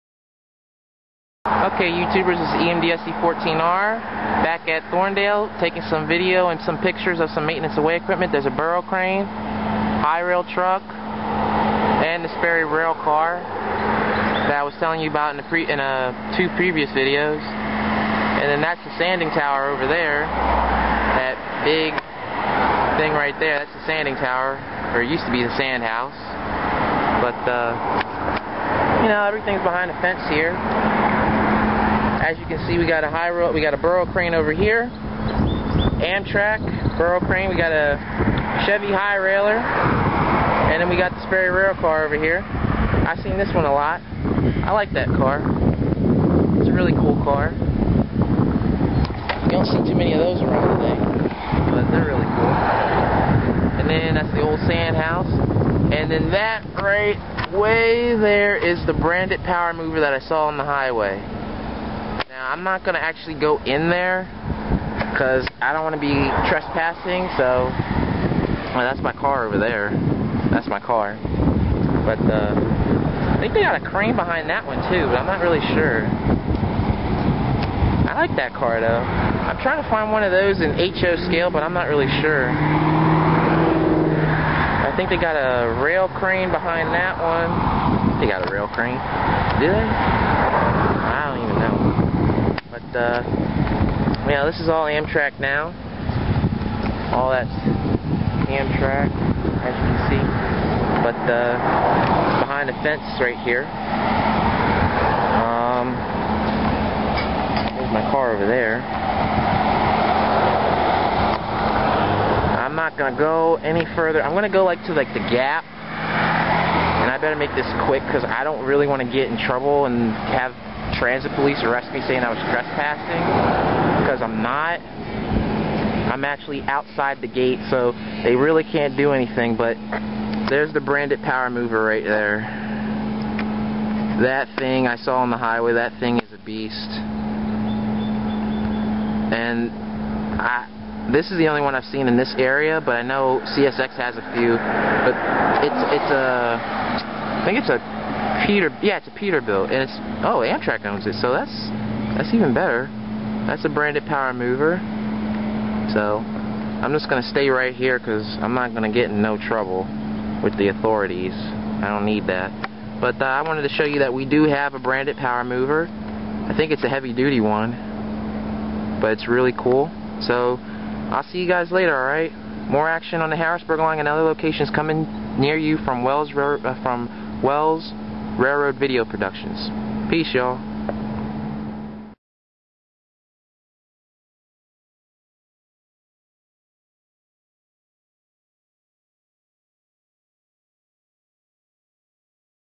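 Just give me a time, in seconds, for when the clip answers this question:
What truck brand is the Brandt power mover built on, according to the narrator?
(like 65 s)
149 s.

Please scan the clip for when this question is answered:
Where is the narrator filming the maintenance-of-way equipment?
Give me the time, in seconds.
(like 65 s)
4 s.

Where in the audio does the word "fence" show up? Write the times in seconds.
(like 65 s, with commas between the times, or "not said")
30 s, 102 s.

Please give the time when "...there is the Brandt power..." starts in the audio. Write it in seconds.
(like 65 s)
58 s.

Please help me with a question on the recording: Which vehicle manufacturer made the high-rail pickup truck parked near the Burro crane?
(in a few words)
Chevy.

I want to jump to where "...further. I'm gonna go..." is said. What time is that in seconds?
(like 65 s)
113 s.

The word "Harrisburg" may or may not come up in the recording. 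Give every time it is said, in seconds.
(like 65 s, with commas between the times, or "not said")
173 s.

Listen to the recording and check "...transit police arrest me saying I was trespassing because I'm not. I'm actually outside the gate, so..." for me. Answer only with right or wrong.
right.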